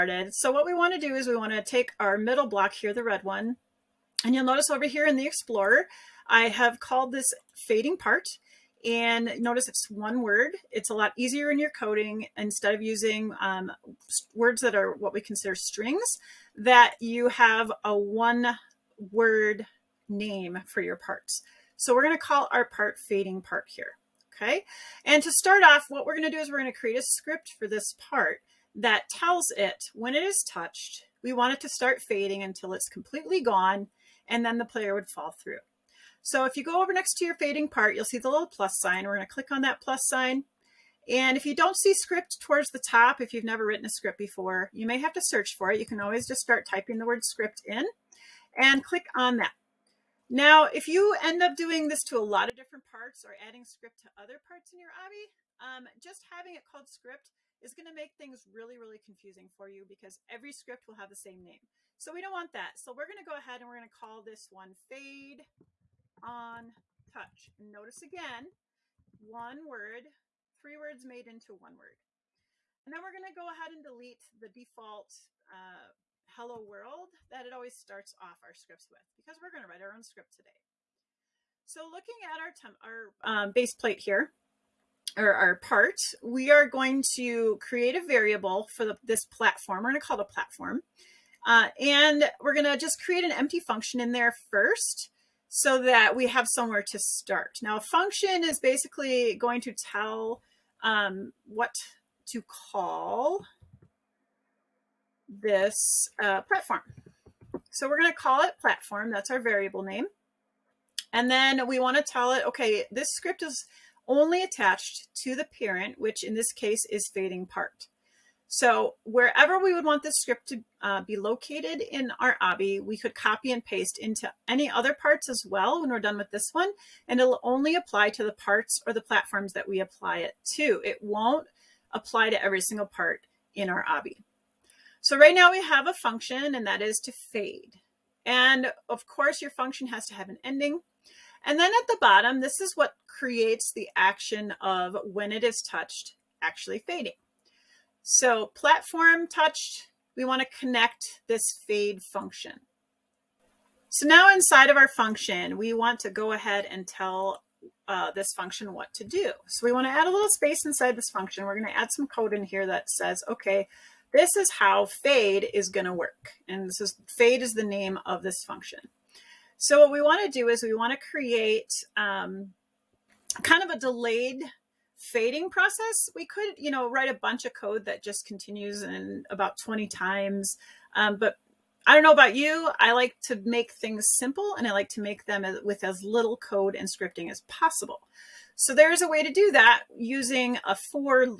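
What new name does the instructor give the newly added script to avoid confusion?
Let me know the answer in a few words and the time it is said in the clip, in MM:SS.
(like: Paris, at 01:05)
fade on touch, at 01:04.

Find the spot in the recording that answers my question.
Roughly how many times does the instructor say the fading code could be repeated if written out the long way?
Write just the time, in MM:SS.
02:59.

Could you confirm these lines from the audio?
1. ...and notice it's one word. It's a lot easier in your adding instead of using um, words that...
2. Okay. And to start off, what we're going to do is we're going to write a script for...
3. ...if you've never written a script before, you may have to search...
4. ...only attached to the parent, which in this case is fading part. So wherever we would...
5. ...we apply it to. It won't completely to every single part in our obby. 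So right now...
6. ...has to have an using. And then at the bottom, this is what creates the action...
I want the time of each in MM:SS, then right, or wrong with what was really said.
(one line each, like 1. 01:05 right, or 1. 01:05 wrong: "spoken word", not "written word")
1. 00:08 wrong: "coding", not "adding"
2. 00:24 wrong: "create", not "write"
3. 00:43 right
4. 01:54 right
5. 02:09 wrong: "apply", not "completely"
6. 02:19 wrong: "ending", not "using".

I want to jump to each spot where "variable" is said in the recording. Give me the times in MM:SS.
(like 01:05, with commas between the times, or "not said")
01:28, 01:49.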